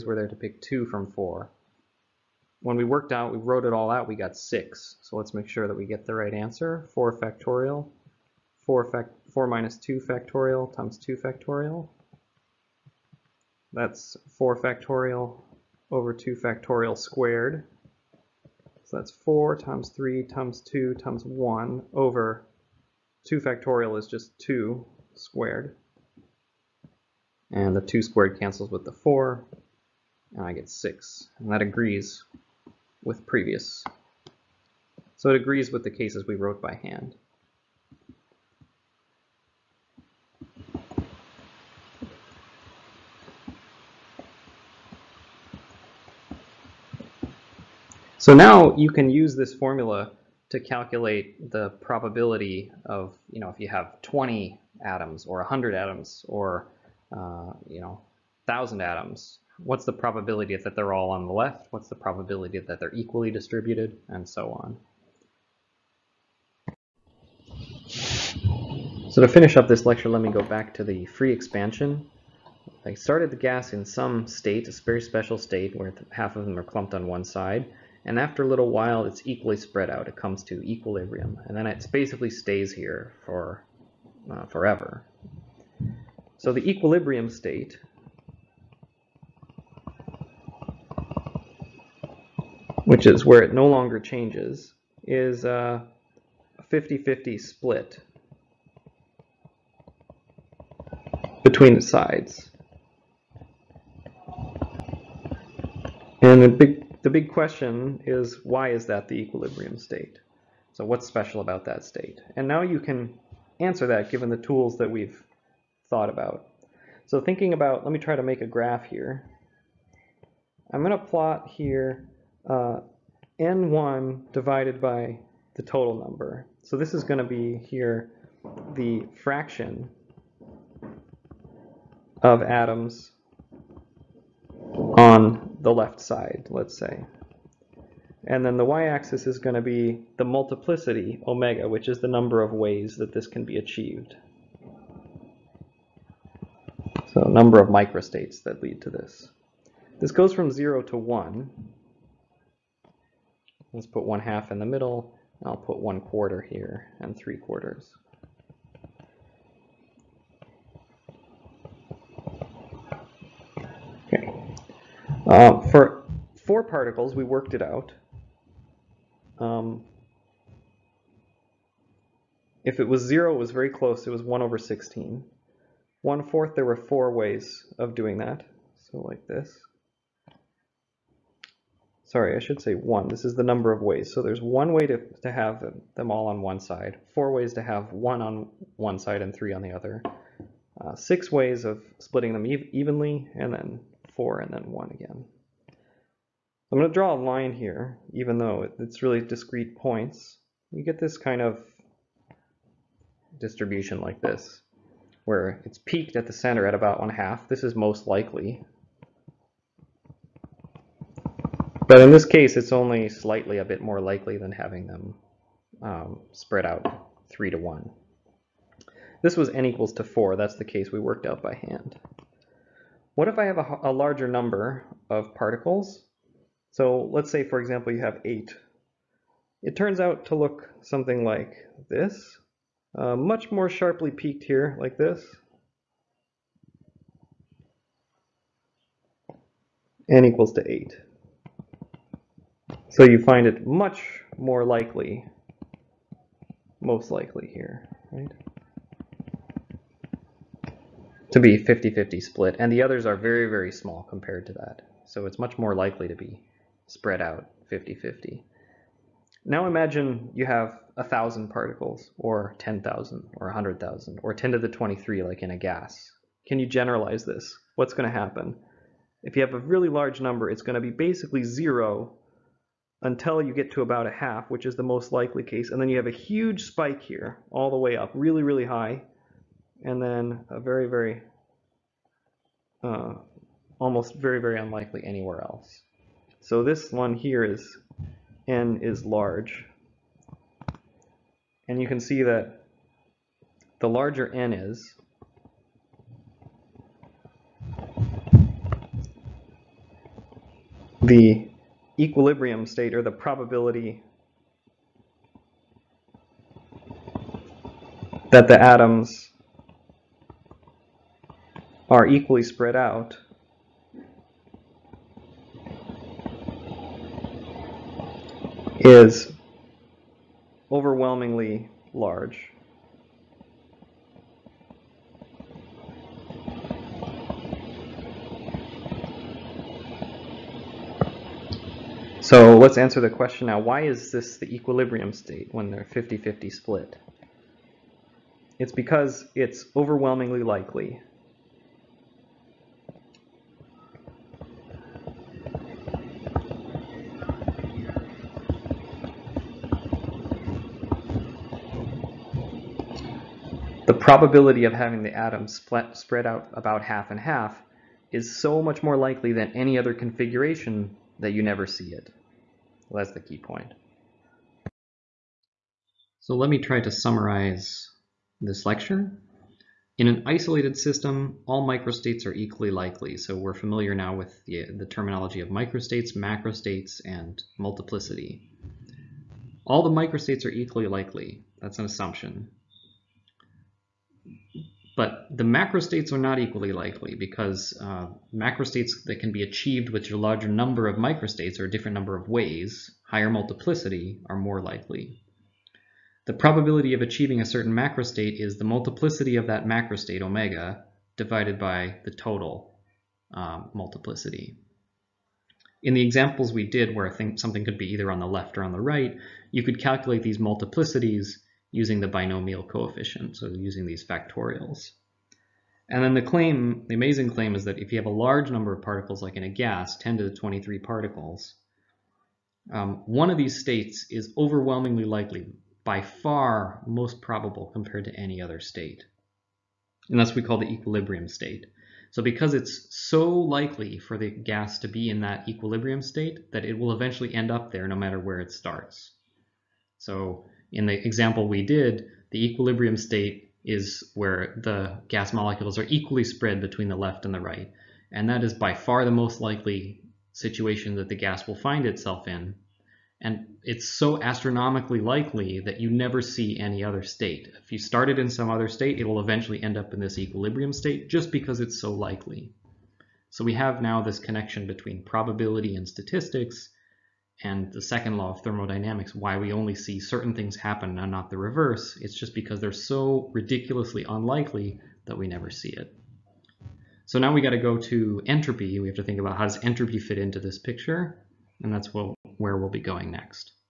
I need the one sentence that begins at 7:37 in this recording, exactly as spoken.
If you started in some other state, it will eventually end up in this equilibrium state just because it's so likely.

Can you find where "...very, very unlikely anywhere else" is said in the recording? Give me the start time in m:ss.
4:44.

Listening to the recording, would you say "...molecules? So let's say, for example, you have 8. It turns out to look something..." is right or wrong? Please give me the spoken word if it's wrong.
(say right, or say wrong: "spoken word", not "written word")
wrong: "particles", not "molecules".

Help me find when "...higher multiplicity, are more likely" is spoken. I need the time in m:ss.
6:33.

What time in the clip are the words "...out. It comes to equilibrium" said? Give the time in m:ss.
1:19.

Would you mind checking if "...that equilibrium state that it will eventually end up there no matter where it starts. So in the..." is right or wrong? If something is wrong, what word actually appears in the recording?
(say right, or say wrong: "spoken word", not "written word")
right.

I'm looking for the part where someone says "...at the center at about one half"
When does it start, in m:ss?
3:26.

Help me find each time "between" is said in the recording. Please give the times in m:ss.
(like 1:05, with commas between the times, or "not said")
1:41, 7:26, 7:44.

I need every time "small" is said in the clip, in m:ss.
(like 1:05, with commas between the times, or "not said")
4:13.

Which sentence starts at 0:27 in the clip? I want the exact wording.
And the 2 squared cancels with the 4, and I get 6.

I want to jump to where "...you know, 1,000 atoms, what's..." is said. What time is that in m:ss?
0:57.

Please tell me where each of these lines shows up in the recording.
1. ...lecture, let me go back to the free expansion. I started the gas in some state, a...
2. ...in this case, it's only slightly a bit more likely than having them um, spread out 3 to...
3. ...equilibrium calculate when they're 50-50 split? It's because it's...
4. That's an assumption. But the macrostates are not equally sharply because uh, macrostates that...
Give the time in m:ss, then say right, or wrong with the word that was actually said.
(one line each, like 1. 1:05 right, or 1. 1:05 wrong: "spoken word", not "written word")
1. 1:09 right
2. 3:31 right
3. 5:34 wrong: "state", not "calculate"
4. 6:21 wrong: "likely", not "sharply".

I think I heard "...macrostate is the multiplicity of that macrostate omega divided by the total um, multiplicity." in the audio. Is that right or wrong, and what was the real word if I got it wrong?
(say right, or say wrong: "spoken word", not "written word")
right.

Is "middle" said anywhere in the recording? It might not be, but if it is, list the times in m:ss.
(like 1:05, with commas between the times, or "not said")
2:34.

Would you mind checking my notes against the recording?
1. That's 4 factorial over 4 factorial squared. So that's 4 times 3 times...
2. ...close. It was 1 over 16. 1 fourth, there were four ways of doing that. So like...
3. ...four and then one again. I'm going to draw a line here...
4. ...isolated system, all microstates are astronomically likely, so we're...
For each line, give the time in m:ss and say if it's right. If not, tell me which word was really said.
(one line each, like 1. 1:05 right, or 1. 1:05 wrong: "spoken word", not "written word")
1. 0:13 wrong: "2", not "4"
2. 2:53 right
3. 3:14 right
4. 6:10 wrong: "equally", not "astronomically".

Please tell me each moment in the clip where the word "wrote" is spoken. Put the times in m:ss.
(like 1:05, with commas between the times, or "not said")
0:03, 0:36.